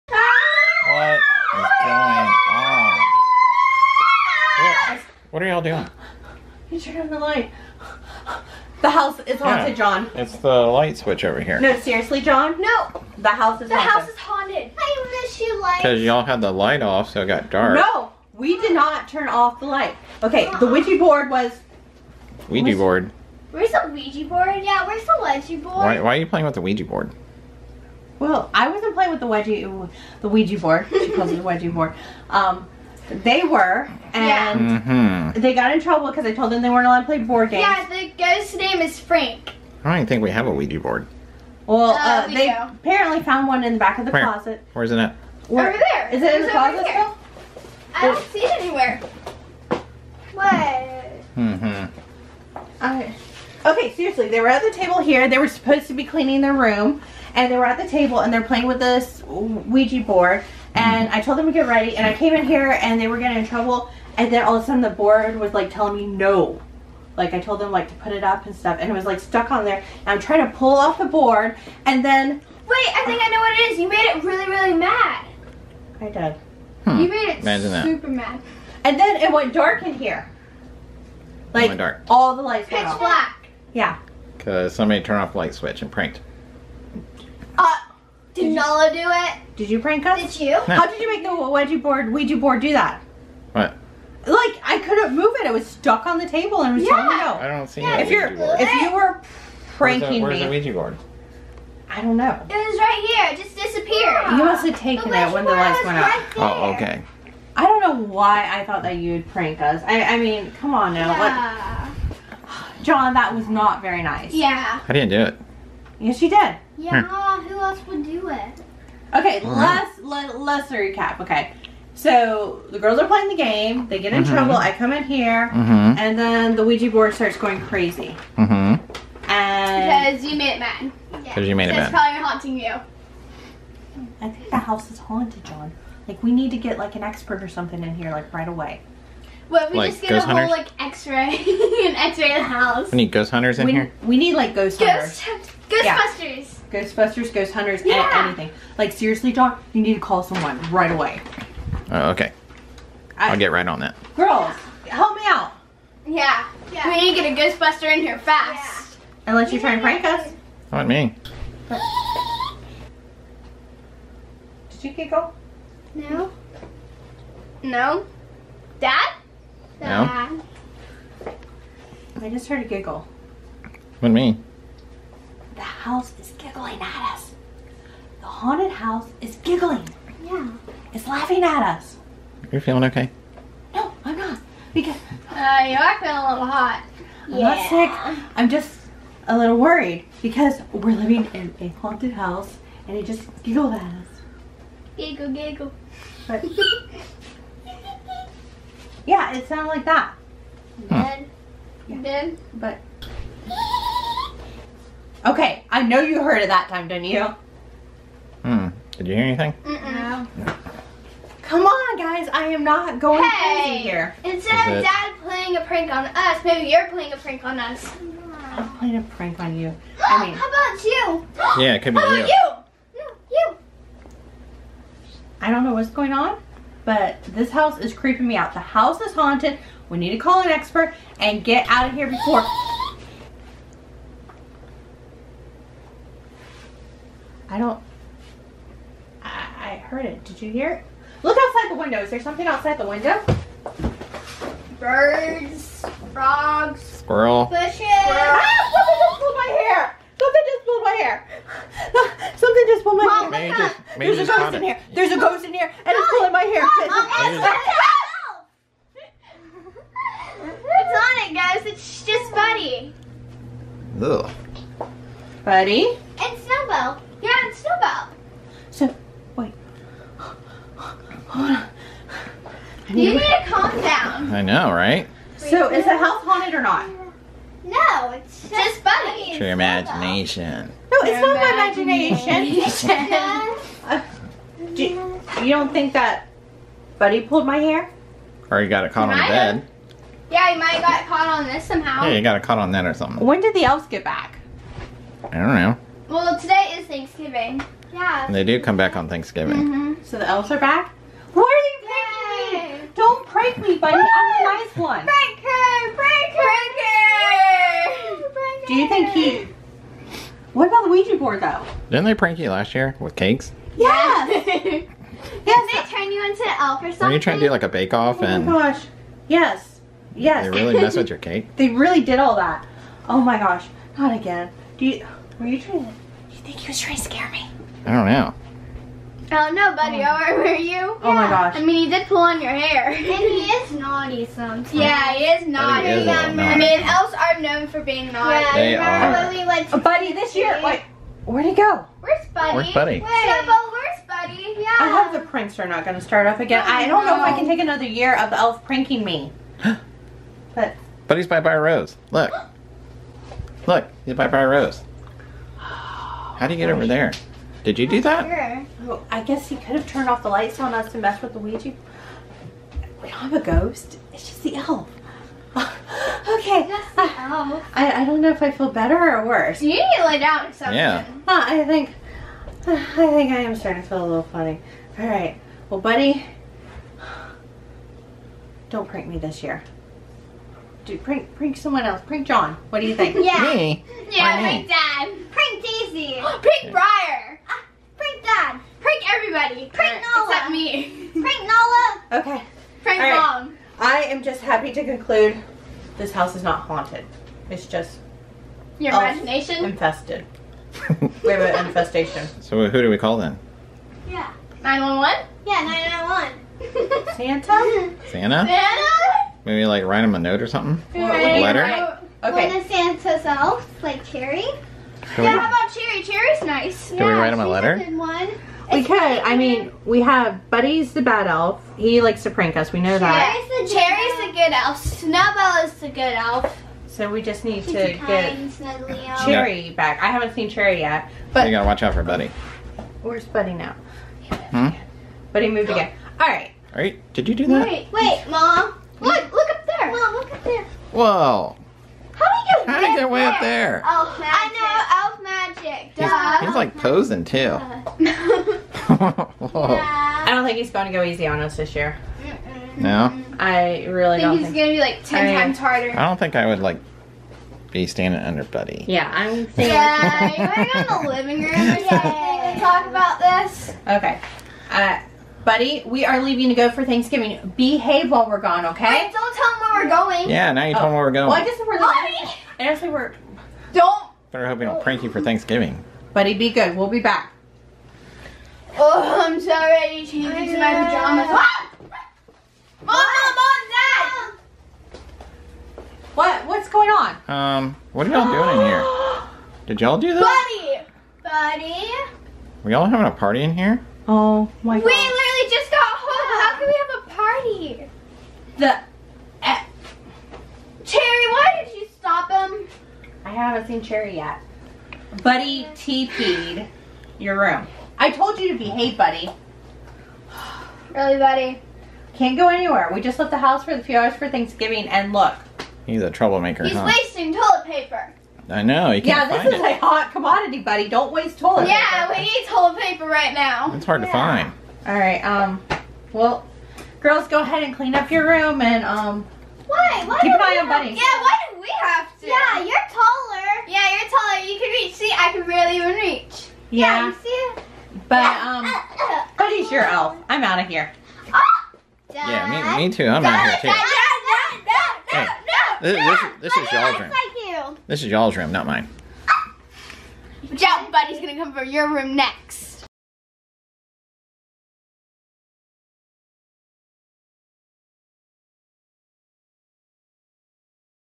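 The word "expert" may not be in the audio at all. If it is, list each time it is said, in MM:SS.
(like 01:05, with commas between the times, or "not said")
02:17, 03:50.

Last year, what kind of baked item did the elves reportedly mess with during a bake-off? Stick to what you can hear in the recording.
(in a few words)
cakes.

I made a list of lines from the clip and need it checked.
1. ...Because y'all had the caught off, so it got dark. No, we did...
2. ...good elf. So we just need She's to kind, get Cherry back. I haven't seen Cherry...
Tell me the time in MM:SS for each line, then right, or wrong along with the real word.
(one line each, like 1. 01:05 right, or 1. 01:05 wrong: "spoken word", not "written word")
1. 00:15 wrong: "light", not "caught"
2. 07:05 right.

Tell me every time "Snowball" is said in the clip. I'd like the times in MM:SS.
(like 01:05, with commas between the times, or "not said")
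04:26, 07:04.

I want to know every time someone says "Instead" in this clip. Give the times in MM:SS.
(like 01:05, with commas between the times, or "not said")
03:34.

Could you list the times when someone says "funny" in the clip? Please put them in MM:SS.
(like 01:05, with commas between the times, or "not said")
04:38, 06:14.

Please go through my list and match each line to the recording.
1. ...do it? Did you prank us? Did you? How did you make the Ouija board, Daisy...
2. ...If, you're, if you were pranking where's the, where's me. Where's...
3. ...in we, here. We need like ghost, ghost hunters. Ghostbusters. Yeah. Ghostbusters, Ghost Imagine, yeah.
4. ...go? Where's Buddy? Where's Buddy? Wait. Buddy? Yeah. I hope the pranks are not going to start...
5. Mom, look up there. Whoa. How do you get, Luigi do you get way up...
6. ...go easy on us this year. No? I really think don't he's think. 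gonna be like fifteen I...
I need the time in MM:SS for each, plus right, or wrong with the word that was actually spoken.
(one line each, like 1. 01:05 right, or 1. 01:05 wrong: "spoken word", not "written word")
1. 01:28 wrong: "Ouija", not "Daisy"
2. 01:37 right
3. 02:23 wrong: "Hunters", not "Imagine"
4. 05:41 right
5. 07:19 wrong: "How", not "Luigi"
6. 07:30 wrong: "ten", not "fifteen".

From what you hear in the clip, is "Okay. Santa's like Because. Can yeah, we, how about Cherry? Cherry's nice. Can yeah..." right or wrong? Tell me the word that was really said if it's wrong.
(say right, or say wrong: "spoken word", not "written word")
wrong: "Cherry", not "Because".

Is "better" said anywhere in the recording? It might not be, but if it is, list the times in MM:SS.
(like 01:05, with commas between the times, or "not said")
06:08, 07:54.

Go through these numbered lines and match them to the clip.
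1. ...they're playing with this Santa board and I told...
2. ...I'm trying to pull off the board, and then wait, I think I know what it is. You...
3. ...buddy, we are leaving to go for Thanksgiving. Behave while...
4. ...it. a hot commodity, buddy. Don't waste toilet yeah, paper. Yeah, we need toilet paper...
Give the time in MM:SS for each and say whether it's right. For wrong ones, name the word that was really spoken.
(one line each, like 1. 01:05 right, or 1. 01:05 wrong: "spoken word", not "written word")
1. 00:58 wrong: "Ouija", not "Santa"
2. 01:10 right
3. 07:45 right
4. 08:39 right.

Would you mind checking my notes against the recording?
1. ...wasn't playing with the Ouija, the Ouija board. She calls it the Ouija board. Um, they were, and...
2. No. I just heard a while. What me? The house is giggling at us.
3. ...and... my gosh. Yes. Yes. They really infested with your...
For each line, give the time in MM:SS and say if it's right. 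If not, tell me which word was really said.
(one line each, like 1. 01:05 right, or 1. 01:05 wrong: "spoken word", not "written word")
1. 00:28 right
2. 02:49 wrong: "giggle", not "while"
3. 05:18 wrong: "messed", not "infested".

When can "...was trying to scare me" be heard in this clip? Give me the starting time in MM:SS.
05:26.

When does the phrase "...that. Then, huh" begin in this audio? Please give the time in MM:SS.
03:19.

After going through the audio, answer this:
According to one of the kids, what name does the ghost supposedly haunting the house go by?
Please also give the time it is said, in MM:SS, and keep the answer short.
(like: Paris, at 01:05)
Frank, at 00:38.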